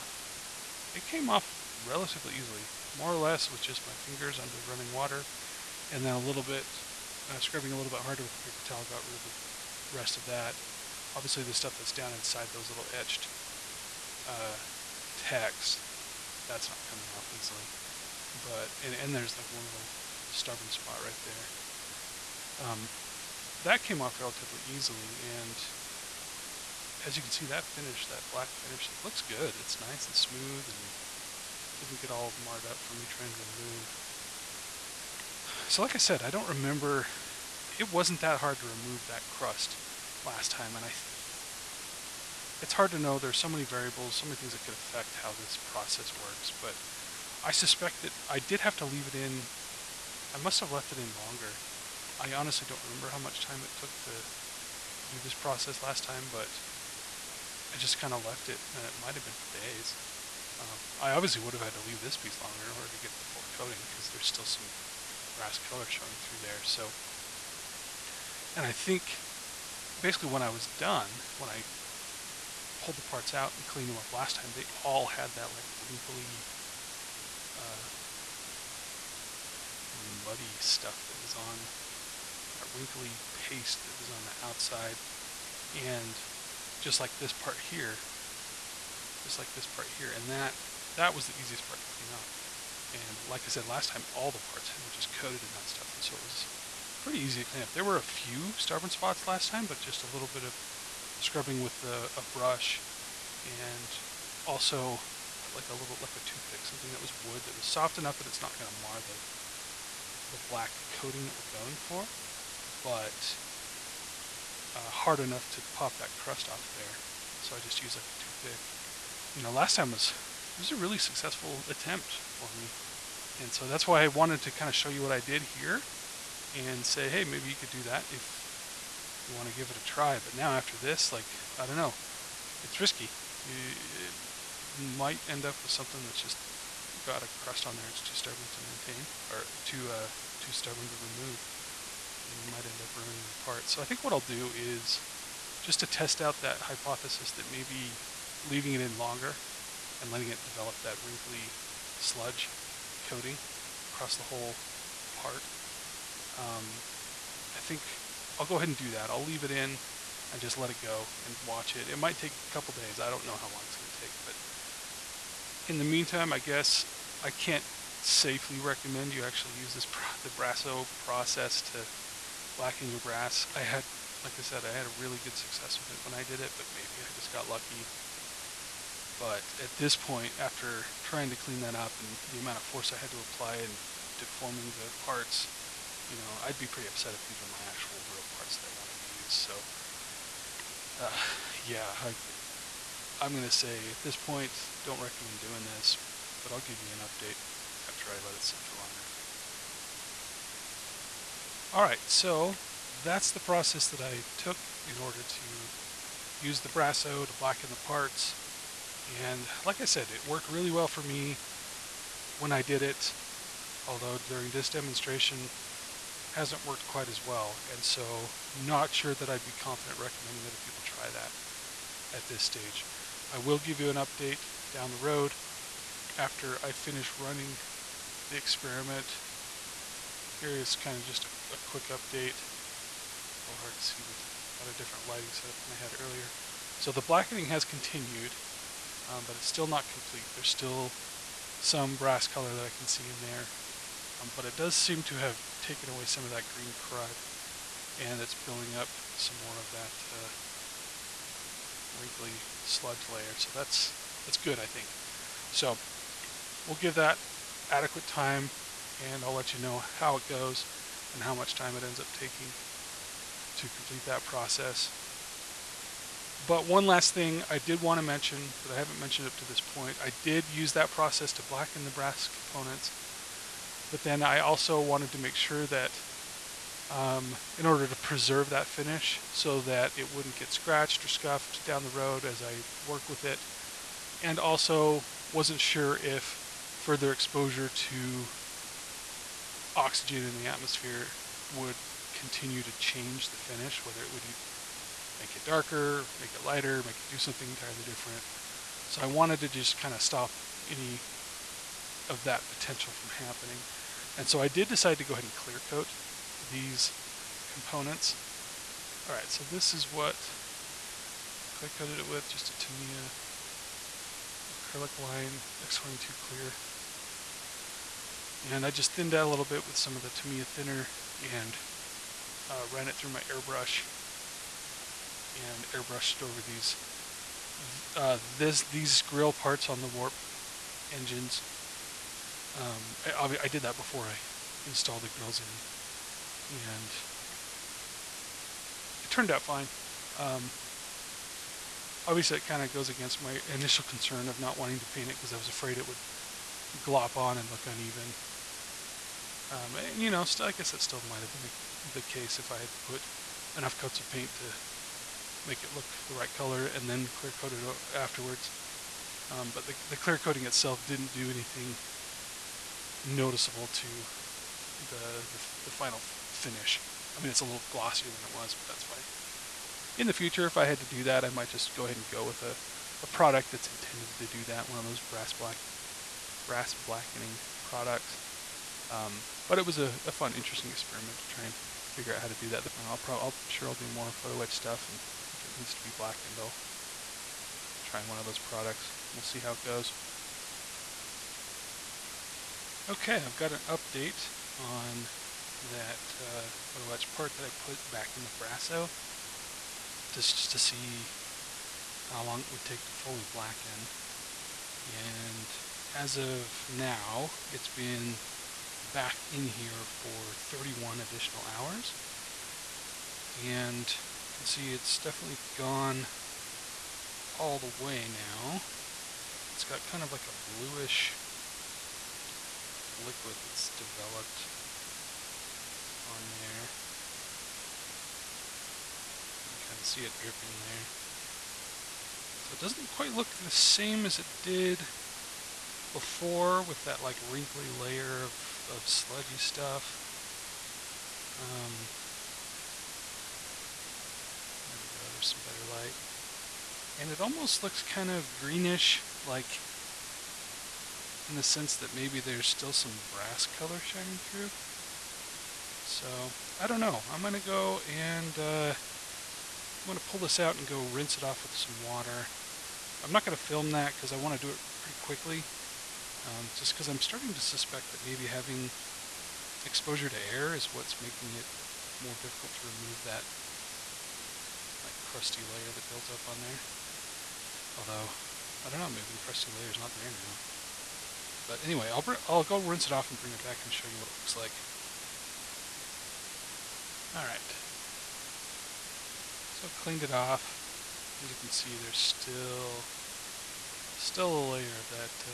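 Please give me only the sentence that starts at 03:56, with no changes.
So the blackening has continued, um, but it's still not complete.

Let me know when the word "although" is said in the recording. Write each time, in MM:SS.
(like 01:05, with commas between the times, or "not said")
03:33, 07:57.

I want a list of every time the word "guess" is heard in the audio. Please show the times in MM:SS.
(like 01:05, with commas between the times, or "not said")
02:46, 05:50.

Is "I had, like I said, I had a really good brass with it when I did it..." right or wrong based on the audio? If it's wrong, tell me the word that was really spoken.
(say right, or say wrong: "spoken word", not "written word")
wrong: "success", not "brass".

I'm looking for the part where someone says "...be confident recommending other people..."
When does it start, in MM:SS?
03:39.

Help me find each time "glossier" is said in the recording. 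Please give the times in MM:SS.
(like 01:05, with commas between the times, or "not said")
06:07.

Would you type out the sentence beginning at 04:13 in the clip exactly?
So that's that's good, I think.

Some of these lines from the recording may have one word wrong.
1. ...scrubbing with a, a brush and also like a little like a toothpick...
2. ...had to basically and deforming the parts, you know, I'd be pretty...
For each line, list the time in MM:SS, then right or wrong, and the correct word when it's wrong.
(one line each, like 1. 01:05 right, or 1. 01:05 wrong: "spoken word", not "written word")
1. 01:41 right
2. 03:02 wrong: "apply", not "basically".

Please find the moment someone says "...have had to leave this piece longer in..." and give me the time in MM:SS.
01:01.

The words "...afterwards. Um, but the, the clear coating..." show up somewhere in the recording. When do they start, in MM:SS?
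05:57.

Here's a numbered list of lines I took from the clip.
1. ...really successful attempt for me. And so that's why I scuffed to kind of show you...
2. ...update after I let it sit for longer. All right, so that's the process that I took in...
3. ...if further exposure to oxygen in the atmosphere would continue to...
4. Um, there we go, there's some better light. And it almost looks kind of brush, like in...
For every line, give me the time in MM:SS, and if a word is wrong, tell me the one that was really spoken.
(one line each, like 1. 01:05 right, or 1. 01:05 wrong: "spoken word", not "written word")
1. 02:00 wrong: "wanted", not "scuffed"
2. 03:17 right
3. 04:45 right
4. 07:21 wrong: "greenish", not "brush".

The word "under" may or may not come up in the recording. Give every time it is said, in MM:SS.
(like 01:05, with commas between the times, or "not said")
00:04.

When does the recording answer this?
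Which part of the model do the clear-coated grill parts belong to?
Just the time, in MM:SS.
05:29.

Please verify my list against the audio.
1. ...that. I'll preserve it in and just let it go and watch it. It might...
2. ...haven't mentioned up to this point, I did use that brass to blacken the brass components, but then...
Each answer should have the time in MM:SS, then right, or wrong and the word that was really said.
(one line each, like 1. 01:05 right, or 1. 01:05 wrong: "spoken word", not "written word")
1. 02:38 wrong: "leave", not "preserve"
2. 04:28 wrong: "process", not "brass".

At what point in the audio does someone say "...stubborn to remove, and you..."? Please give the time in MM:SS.
02:20.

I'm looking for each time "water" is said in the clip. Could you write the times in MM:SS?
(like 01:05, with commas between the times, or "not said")
00:04, 07:41.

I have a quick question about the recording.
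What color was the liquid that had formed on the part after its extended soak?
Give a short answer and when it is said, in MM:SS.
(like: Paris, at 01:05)
bluish, at 07:00.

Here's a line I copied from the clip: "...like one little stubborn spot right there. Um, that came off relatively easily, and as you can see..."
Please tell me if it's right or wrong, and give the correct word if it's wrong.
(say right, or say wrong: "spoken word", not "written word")
right.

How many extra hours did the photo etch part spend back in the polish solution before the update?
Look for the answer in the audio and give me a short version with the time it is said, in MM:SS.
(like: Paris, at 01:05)
31, at 06:50.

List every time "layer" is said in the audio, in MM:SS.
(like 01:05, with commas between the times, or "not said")
04:13, 07:17, 07:55, 07:59, 08:14.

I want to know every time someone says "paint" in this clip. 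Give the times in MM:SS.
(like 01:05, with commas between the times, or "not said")
05:44, 05:54.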